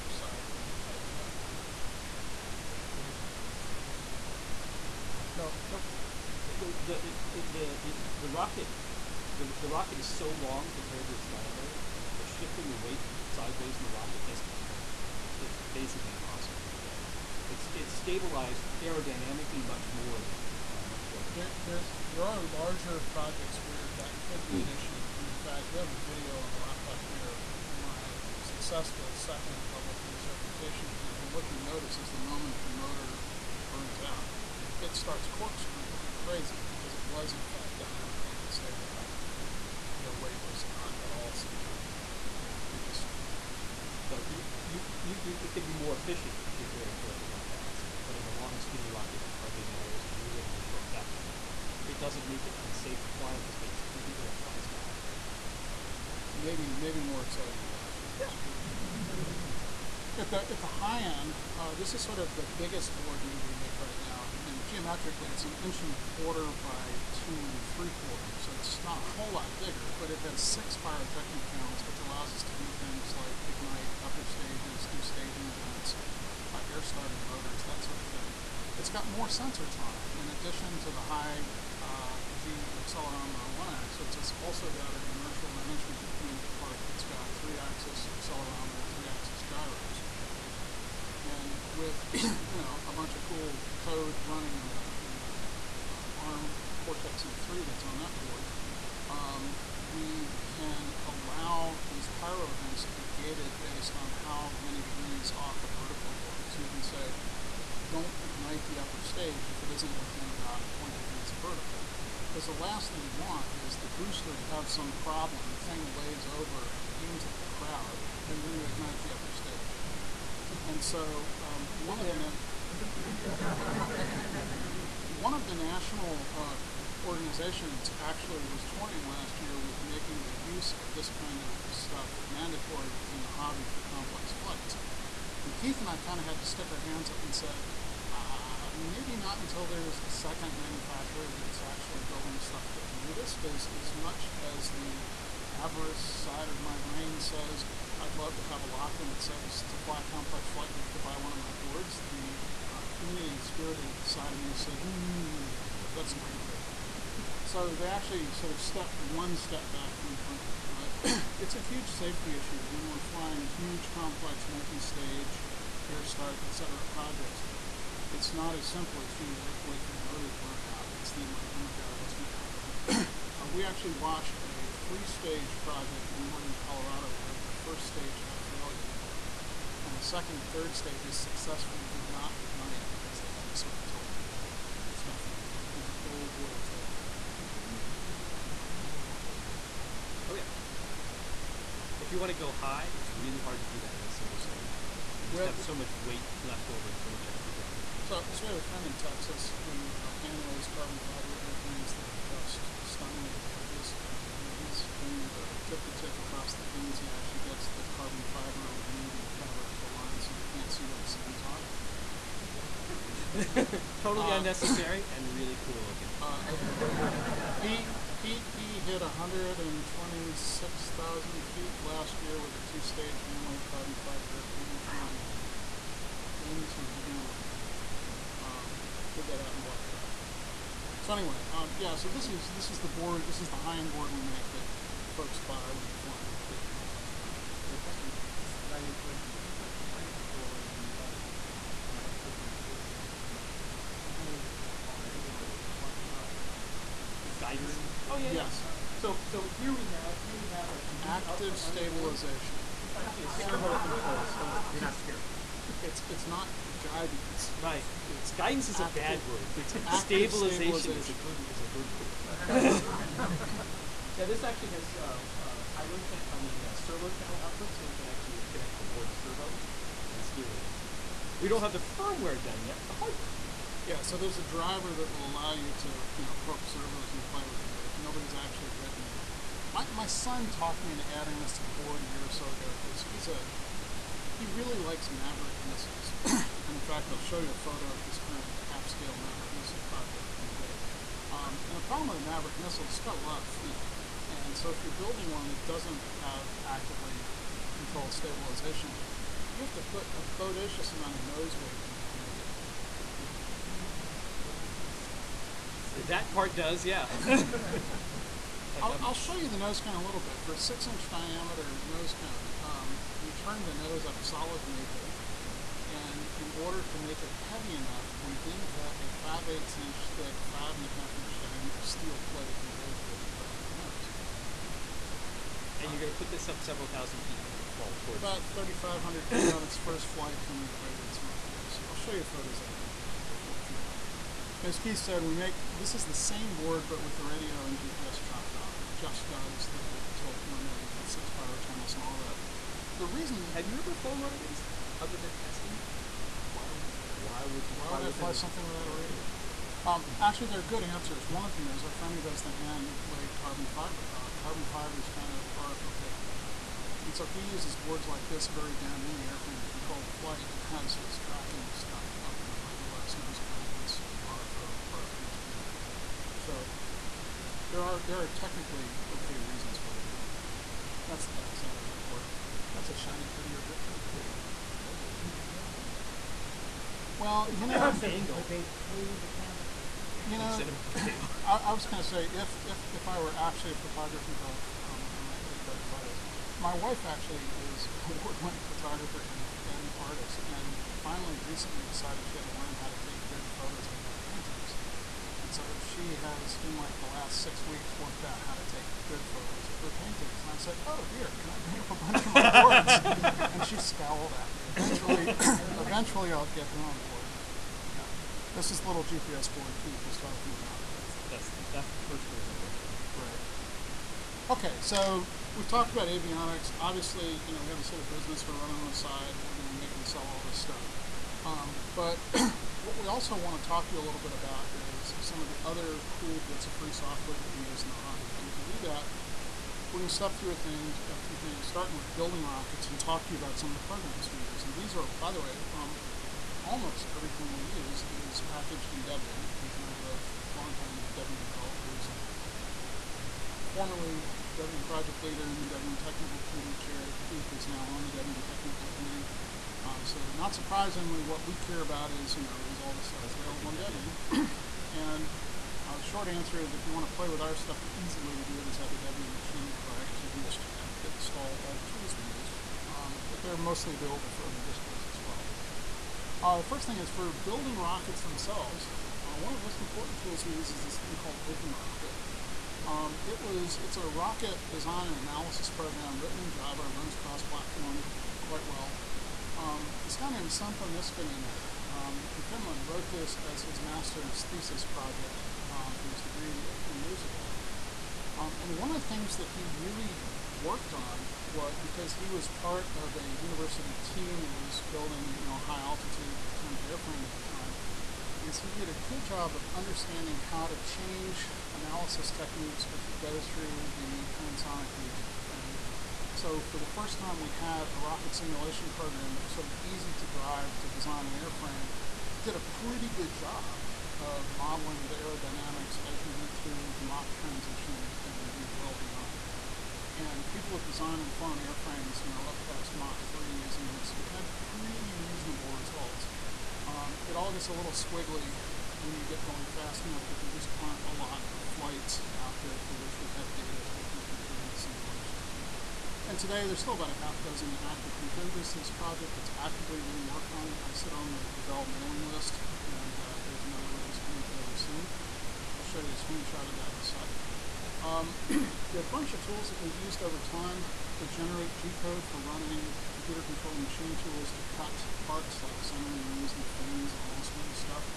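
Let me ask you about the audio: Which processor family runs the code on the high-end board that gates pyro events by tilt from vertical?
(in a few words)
ARM Cortex M3.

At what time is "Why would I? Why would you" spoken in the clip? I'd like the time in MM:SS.
05:46.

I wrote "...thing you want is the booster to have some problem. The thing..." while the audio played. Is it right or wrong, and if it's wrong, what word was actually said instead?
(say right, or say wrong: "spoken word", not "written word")
right.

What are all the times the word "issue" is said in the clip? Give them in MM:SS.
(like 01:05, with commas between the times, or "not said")
00:24, 02:42.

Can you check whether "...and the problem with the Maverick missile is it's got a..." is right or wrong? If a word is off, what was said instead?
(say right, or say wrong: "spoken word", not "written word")
right.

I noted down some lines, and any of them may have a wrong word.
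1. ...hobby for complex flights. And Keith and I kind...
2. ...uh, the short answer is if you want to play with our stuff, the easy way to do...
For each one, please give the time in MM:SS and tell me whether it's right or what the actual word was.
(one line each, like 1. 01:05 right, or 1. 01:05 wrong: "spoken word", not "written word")
1. 02:13 right
2. 07:35 right.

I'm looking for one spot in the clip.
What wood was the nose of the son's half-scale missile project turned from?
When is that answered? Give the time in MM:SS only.
05:14.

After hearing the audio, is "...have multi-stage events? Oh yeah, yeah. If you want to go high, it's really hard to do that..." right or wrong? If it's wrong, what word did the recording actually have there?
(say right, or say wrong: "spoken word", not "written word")
wrong: "rockets", not "events".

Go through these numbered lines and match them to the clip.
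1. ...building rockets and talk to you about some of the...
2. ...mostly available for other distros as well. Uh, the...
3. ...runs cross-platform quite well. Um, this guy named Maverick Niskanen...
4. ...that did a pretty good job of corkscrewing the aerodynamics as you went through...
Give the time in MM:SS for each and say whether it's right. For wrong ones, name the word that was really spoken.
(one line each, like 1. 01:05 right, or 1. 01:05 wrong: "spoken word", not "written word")
1. 07:12 right
2. 07:43 right
3. 07:56 wrong: "Sampo", not "Maverick"
4. 08:32 wrong: "modeling", not "corkscrewing".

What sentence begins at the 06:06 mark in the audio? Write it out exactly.
So there are there are technically okay reasons for it, but that's the back side of that board.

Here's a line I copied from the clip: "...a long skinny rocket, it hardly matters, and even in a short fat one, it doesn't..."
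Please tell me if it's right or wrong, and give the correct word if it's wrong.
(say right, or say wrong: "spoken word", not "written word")
right.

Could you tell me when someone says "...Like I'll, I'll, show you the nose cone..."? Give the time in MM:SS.
05:08.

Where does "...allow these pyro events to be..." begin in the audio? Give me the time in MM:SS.
01:41.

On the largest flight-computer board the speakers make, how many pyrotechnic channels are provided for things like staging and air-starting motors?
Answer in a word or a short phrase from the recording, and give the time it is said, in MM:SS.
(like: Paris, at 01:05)
6, at 01:10.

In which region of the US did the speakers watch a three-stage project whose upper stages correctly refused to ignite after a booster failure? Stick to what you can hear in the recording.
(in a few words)
Northern Colorado.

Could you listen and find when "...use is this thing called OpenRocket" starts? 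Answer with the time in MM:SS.
07:50.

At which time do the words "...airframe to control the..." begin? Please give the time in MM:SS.
05:59.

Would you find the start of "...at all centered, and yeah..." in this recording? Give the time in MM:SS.
00:41.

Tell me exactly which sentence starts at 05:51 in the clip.
One of them is our friend who does the hand laid carbon fiber.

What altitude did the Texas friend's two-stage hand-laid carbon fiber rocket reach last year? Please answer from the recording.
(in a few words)
126,000 feet.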